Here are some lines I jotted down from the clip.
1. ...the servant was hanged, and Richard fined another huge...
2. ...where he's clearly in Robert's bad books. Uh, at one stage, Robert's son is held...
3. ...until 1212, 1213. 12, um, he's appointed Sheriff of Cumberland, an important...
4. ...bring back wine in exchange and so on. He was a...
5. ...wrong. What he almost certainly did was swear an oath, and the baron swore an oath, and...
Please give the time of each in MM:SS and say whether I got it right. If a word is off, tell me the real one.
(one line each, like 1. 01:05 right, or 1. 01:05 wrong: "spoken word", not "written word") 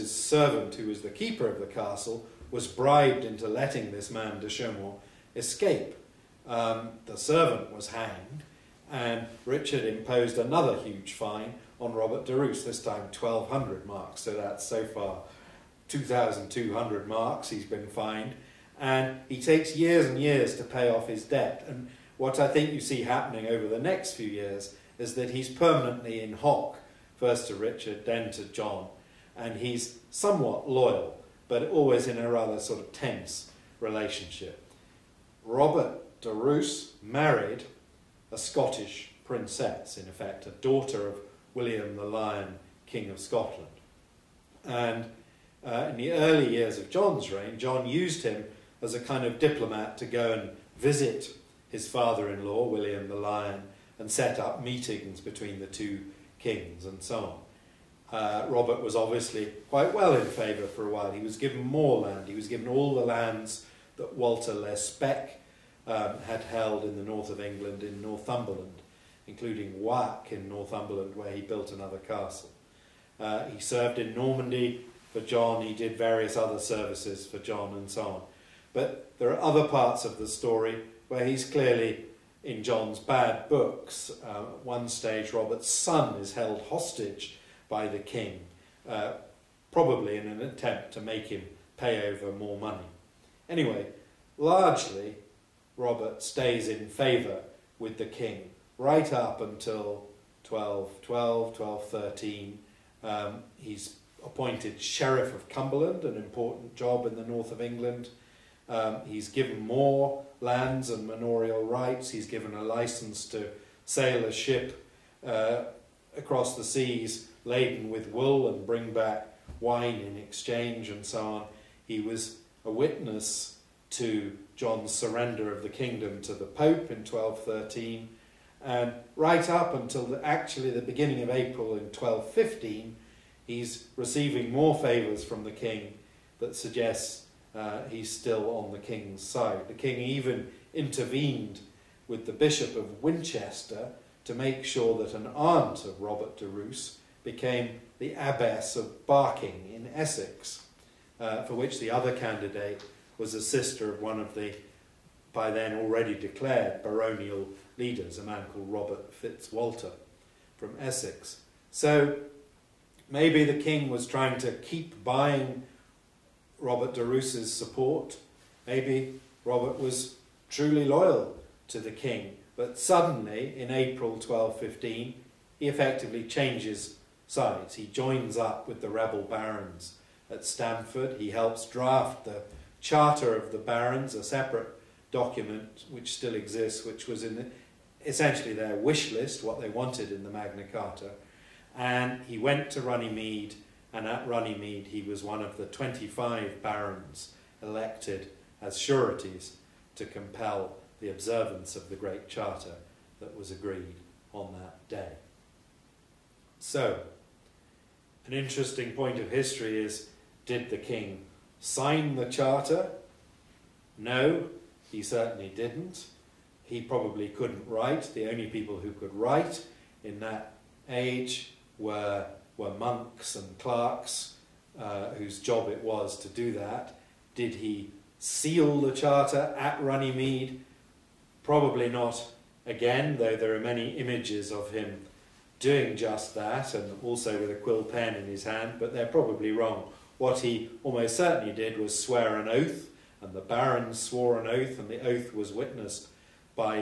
1. 00:07 wrong: "imposed", not "fined"
2. 01:21 wrong: "John", not "Robert"
3. 01:39 right
4. 01:58 right
5. 03:59 right.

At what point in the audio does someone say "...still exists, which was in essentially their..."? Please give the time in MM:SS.
03:06.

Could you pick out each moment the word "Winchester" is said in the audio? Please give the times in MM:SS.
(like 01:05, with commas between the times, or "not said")
02:23.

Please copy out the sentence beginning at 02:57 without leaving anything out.
He joins up with the rebel barons at Stamford.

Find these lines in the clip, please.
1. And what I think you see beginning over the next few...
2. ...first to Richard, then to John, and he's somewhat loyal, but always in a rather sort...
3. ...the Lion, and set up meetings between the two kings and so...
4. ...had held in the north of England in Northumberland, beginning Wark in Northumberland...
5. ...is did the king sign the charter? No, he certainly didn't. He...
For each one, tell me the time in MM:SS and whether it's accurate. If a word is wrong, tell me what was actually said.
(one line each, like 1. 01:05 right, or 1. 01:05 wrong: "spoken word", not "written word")
1. 00:21 wrong: "happening", not "beginning"
2. 00:27 right
3. 00:53 right
4. 01:06 wrong: "including", not "beginning"
5. 03:29 right.